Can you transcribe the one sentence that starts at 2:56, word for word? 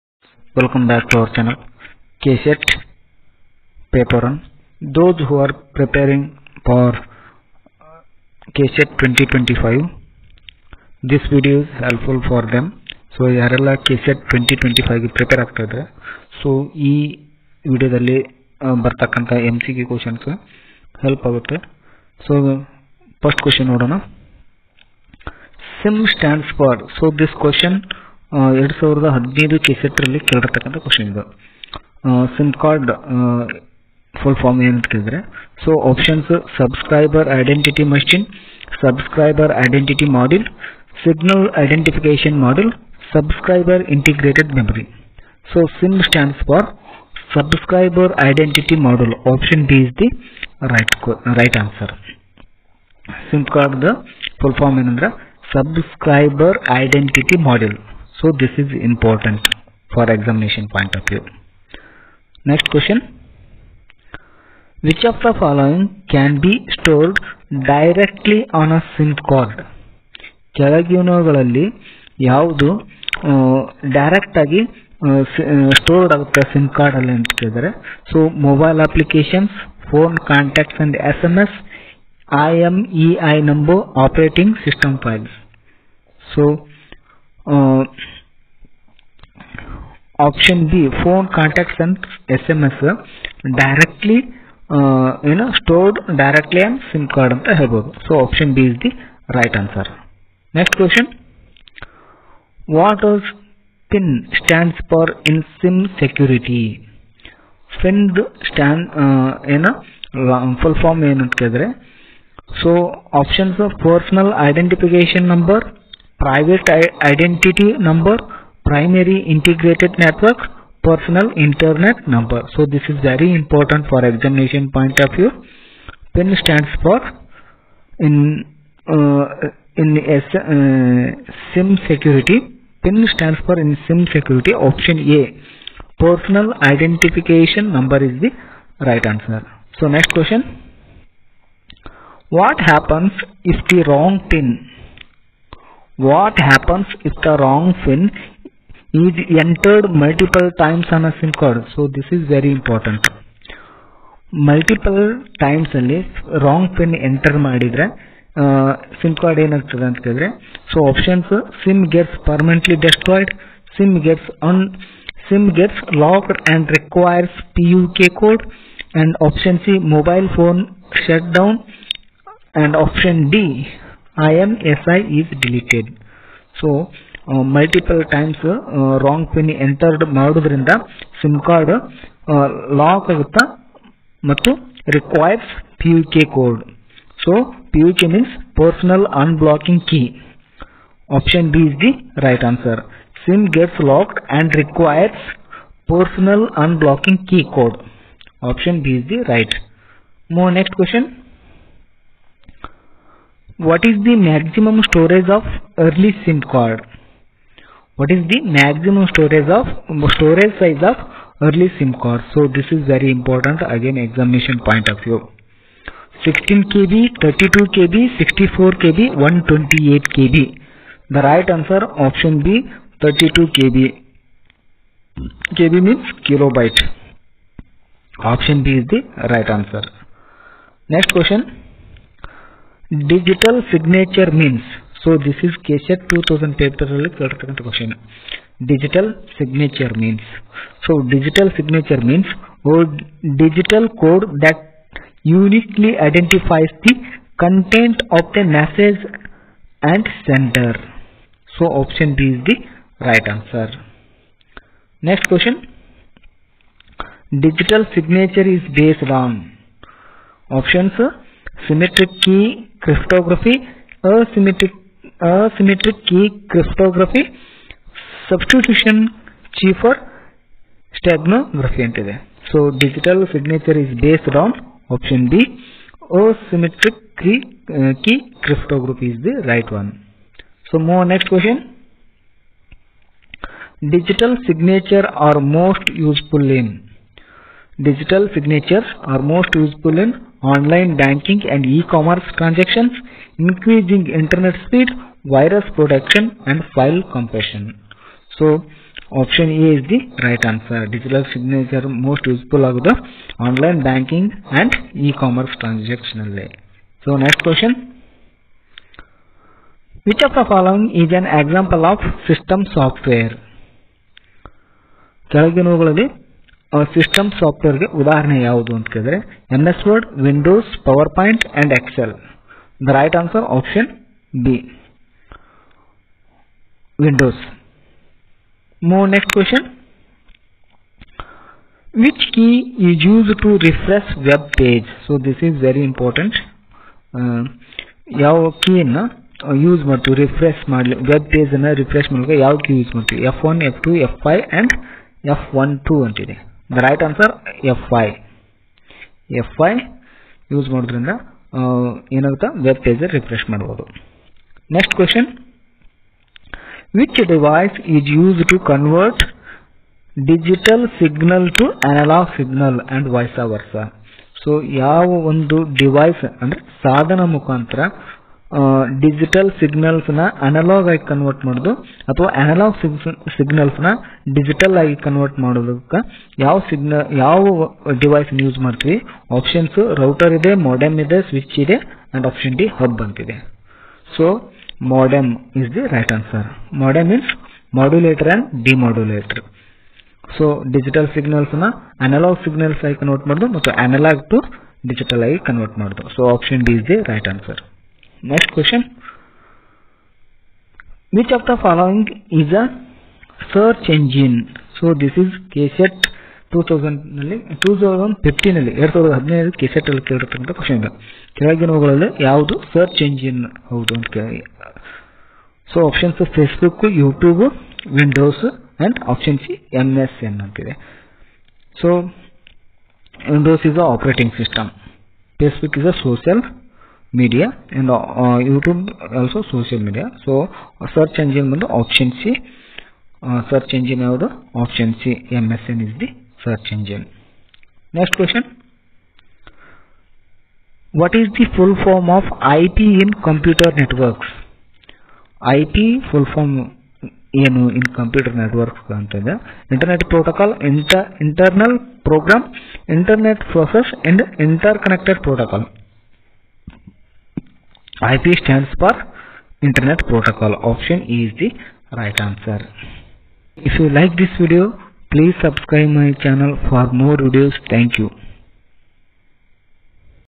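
So, uh, multiple times uh, wrong pin entered Madhurinda, SIM card uh, lock agutta, matu requires PUK code.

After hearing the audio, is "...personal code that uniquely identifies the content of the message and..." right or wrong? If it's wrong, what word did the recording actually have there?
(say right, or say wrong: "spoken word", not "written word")
wrong: "digital", not "personal".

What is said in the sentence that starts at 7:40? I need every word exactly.
Option E is the right answer.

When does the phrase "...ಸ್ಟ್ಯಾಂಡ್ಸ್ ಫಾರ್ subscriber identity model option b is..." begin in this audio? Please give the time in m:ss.
0:46.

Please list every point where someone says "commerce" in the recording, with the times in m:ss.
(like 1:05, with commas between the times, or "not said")
4:51, 5:04.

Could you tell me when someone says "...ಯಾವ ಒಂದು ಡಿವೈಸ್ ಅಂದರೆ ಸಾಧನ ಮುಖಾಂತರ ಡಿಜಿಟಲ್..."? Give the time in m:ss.
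6:04.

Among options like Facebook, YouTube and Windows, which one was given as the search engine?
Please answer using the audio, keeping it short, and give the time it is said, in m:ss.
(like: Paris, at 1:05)
MSN, at 7:15.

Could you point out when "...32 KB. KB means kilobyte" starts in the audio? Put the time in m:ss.
3:43.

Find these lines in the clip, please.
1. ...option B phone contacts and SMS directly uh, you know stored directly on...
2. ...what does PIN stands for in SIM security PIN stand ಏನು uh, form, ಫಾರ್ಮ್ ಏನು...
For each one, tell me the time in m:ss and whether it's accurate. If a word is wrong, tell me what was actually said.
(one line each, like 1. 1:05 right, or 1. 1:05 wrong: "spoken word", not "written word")
1. 1:30 right
2. 1:42 right.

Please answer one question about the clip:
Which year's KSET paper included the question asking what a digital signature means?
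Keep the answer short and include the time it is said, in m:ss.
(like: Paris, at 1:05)
2010, at 3:55.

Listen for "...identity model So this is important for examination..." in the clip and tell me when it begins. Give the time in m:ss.
0:56.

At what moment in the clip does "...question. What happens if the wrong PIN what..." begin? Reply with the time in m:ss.
2:20.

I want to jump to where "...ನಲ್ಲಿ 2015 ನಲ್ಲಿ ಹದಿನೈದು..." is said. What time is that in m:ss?
6:47.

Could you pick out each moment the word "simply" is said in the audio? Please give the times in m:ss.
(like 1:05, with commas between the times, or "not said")
not said.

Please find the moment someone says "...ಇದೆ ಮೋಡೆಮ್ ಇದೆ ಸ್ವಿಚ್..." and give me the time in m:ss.
6:20.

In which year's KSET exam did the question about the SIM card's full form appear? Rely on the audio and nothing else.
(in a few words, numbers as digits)
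2015.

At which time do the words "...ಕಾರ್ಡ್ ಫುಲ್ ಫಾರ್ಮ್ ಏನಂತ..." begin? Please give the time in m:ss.
0:32.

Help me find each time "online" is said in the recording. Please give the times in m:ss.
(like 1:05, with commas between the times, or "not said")
4:50, 5:03.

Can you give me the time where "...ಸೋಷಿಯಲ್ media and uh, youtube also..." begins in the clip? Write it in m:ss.
7:06.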